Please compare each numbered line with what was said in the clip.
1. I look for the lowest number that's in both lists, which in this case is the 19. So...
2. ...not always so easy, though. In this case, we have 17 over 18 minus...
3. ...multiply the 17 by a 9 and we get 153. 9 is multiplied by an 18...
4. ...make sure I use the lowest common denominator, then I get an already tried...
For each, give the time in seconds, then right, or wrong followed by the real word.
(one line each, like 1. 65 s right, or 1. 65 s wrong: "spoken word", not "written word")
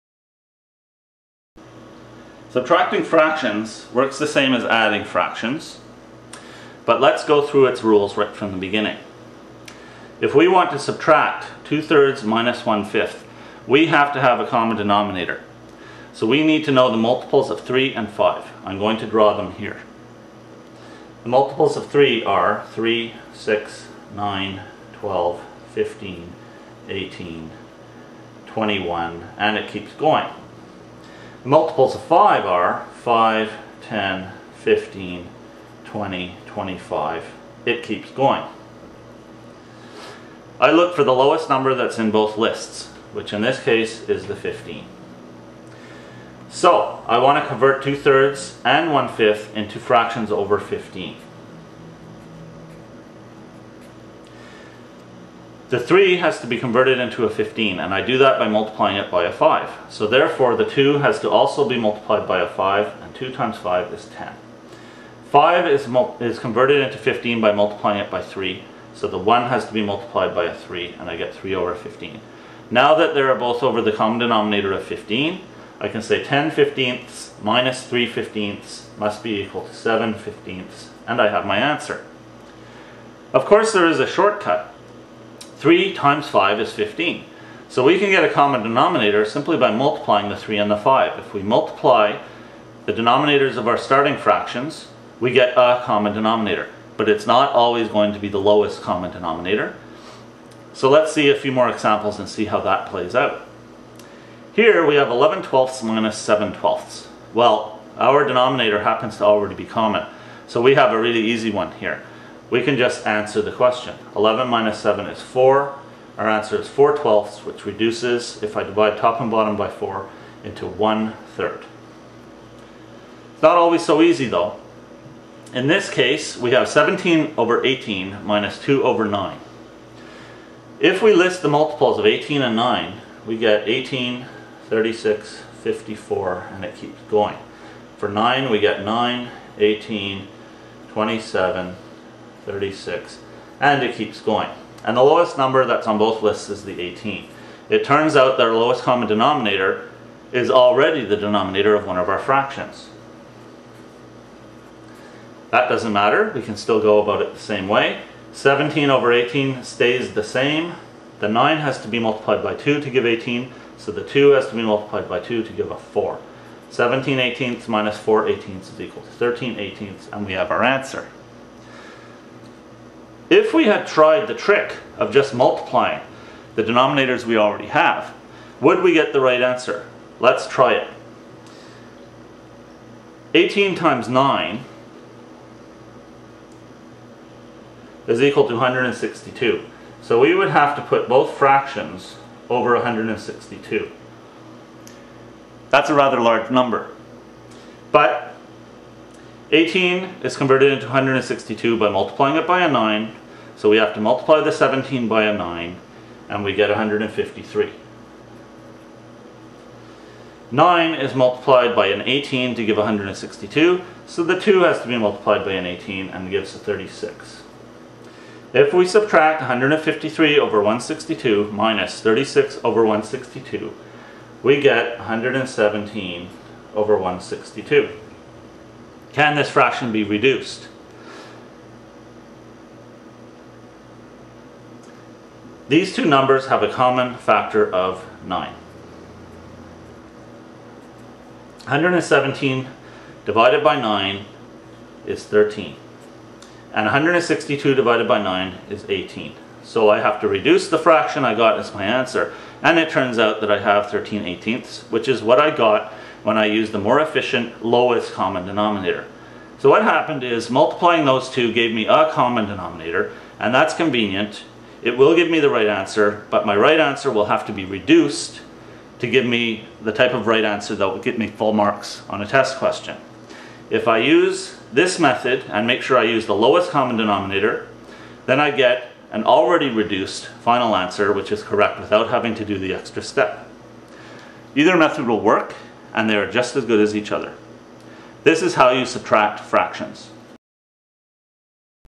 1. 40 s wrong: "15", not "19"
2. 123 s right
3. 204 s right
4. 275 s wrong: "reduced", not "tried".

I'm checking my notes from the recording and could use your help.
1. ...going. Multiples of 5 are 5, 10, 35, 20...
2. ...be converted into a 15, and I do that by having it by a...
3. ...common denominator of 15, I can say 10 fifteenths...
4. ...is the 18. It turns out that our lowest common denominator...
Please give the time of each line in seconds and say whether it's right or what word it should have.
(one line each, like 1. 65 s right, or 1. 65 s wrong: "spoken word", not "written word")
1. 29 s wrong: "15", not "35"
2. 56 s wrong: "multiplying", not "having"
3. 73 s right
4. 146 s right.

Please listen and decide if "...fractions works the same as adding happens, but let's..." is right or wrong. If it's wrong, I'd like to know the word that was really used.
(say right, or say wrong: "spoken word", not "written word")
wrong: "fractions", not "happens".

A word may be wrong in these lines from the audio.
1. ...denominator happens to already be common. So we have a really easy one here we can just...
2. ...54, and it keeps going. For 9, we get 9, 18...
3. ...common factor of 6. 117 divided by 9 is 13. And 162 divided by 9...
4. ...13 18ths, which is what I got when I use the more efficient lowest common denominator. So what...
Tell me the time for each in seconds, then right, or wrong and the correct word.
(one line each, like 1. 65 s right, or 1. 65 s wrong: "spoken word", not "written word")
1. 108 s right
2. 135 s right
3. 236 s wrong: "9", not "6"
4. 253 s right.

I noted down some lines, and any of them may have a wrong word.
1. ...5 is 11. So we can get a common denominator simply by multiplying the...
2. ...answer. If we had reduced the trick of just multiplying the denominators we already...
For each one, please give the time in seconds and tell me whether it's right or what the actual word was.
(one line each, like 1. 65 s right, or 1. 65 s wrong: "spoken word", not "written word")
1. 86 s wrong: "15", not "11"
2. 170 s wrong: "tried", not "reduced".